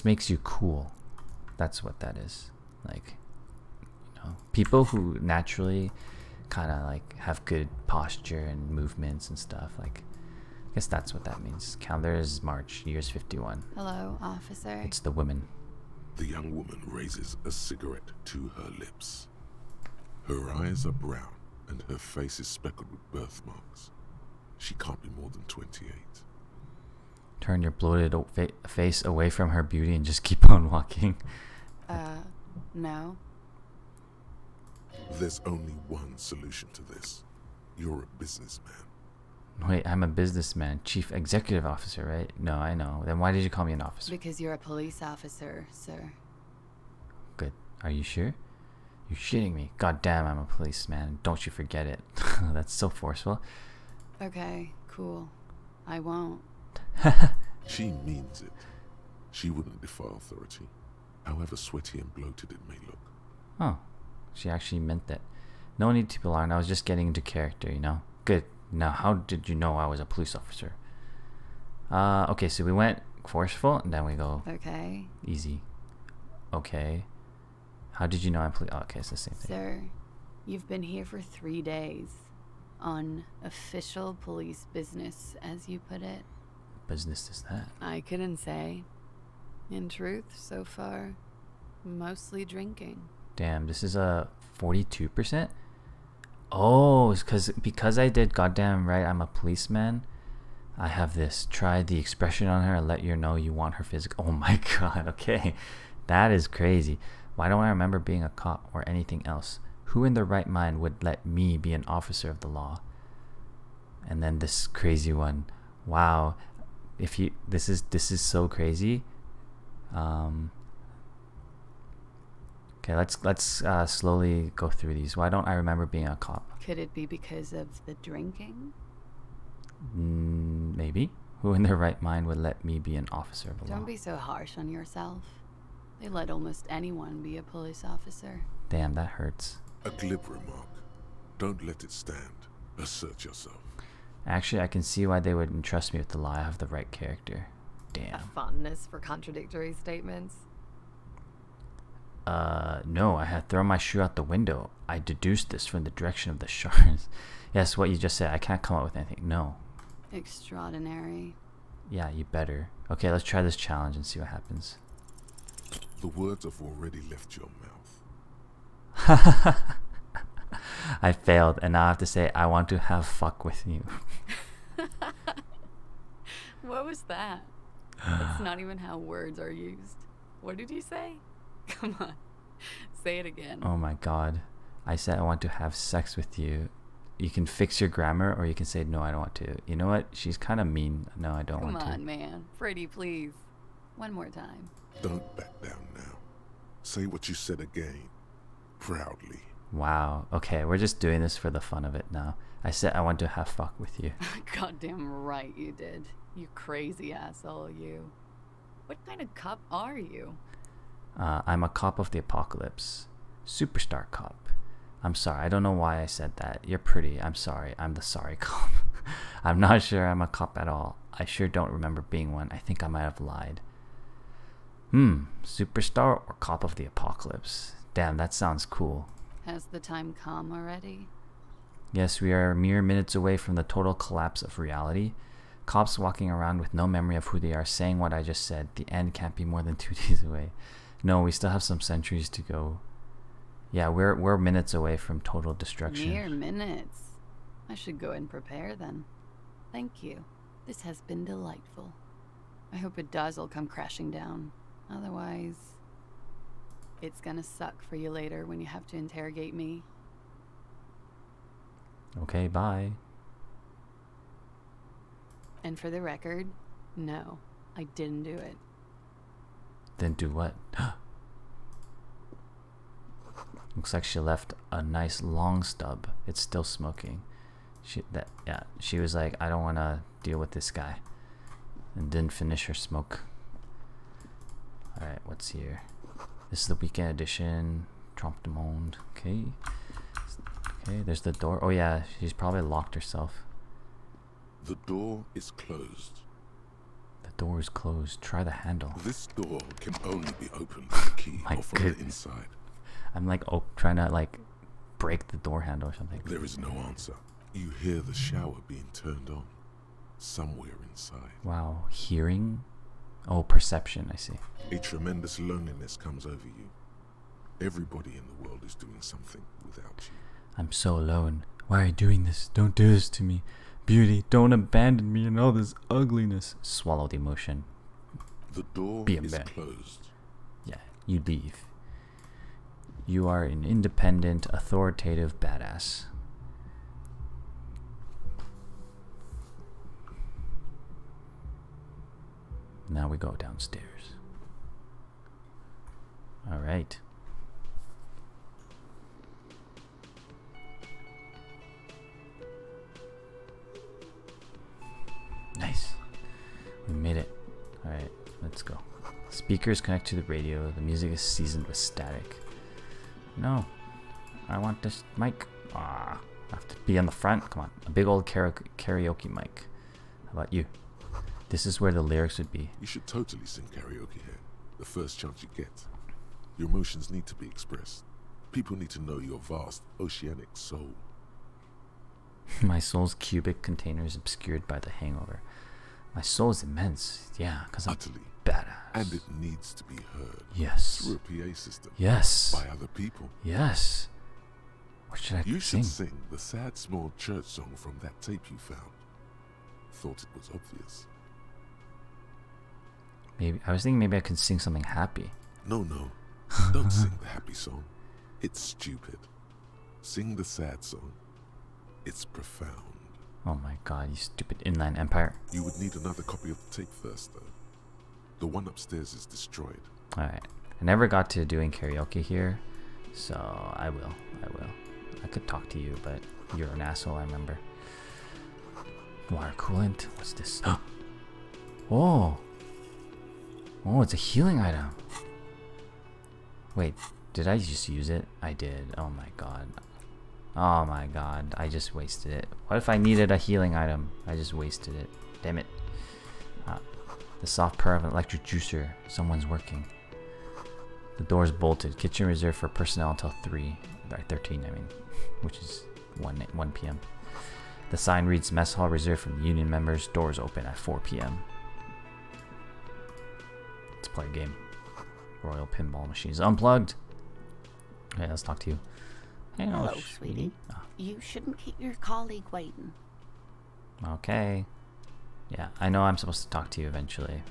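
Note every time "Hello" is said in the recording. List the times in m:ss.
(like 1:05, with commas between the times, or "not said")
0:13, 7:49.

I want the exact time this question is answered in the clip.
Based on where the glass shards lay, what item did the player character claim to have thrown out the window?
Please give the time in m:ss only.
2:33.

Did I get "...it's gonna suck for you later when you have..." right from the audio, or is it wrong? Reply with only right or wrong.
right.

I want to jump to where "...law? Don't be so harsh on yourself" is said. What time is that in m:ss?
2:13.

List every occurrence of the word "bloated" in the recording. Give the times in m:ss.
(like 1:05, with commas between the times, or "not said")
0:27, 1:02.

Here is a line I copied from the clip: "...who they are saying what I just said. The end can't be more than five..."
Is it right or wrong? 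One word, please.
wrong.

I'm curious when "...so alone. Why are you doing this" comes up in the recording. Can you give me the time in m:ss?
5:20.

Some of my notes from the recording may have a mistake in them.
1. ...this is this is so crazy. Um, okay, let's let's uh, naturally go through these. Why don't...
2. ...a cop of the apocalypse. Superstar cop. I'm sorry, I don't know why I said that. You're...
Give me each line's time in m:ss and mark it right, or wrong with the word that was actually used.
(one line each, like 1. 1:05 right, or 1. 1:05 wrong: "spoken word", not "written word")
1. 1:57 wrong: "slowly", not "naturally"
2. 3:31 right.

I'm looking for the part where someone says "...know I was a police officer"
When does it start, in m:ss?
1:09.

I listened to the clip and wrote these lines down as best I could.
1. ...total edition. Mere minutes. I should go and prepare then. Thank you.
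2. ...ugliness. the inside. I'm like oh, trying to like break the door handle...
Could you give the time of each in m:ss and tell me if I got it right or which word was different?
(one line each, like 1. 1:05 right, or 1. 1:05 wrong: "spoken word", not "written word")
1. 4:05 wrong: "destruction", not "edition"
2. 5:01 wrong: "goodness", not "ugliness".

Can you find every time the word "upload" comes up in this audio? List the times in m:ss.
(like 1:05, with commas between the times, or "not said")
not said.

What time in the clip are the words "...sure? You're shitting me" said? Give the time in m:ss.
0:48.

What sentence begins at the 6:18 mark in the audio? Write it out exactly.
People need to know your vast, oceanic soul.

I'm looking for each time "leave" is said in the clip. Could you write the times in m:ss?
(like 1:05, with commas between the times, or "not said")
5:31.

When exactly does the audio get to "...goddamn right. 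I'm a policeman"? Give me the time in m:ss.
1:38.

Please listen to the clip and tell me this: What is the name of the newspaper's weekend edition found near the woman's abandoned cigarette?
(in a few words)
Trompe de Monde.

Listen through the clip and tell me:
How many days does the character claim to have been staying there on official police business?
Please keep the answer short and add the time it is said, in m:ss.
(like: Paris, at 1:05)
3, at 1:21.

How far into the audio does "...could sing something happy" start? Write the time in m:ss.
6:44.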